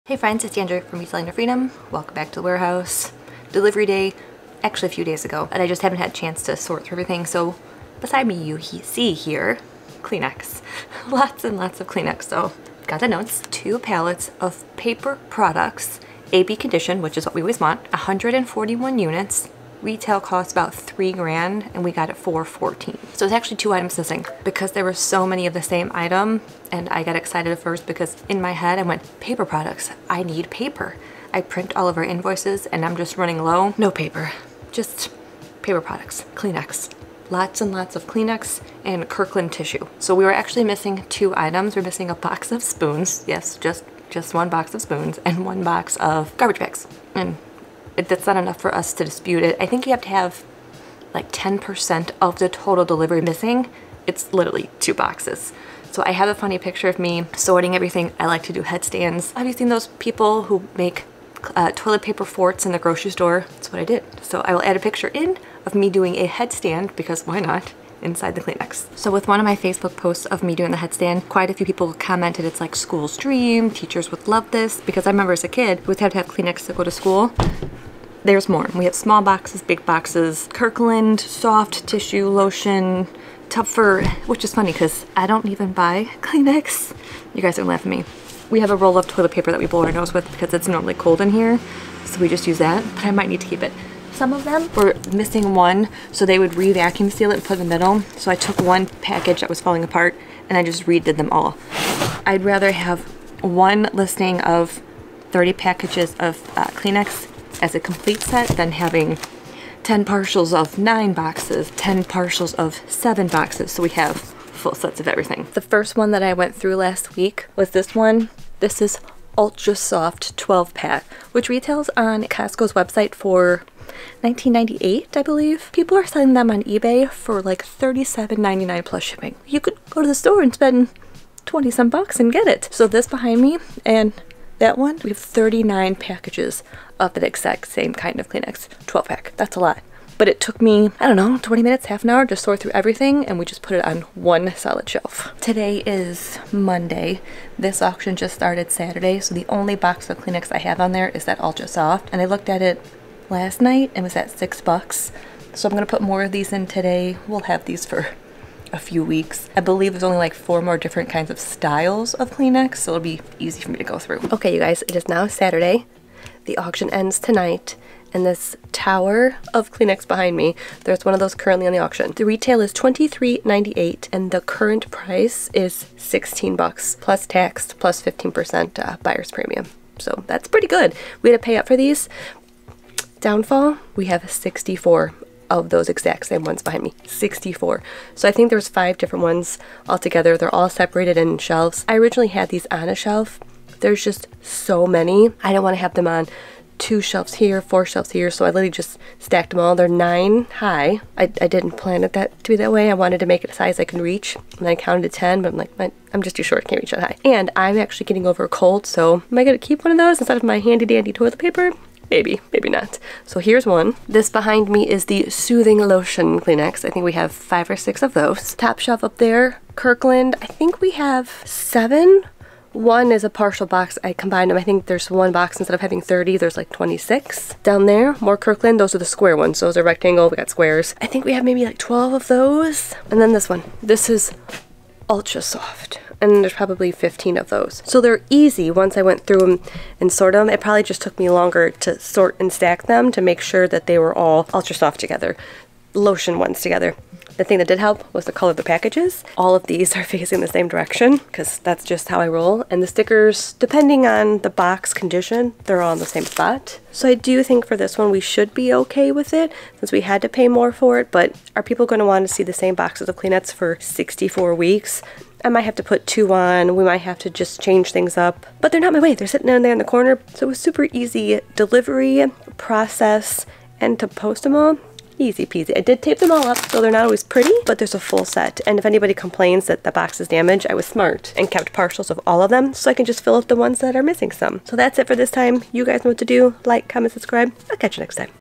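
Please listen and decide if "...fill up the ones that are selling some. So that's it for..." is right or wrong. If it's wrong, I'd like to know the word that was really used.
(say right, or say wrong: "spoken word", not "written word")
wrong: "missing", not "selling".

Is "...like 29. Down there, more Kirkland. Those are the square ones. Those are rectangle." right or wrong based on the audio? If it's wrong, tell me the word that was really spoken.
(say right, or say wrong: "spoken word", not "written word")
wrong: "26", not "29".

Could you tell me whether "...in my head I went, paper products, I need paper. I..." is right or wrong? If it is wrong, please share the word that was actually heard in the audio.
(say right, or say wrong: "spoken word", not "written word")
right.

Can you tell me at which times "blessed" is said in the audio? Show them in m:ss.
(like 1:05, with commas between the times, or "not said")
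not said.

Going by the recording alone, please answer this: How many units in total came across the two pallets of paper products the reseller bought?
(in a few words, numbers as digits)
141.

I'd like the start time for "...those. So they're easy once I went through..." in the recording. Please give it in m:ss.
3:57.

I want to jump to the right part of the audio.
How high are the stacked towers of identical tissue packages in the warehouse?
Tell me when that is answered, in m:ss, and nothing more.
3:19.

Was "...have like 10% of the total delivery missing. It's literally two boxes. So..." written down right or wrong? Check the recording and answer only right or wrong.
right.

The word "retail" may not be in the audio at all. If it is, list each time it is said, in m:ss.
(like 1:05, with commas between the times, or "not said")
0:19, 2:01, 2:52.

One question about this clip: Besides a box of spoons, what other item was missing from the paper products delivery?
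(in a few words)
Garbage bags.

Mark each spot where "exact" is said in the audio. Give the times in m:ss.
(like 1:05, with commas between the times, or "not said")
2:17, 3:05.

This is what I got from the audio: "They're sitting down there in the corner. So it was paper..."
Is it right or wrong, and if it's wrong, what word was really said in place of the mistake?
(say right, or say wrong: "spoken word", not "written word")
wrong: "super", not "paper".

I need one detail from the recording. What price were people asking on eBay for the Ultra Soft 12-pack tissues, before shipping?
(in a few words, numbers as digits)
$37.99.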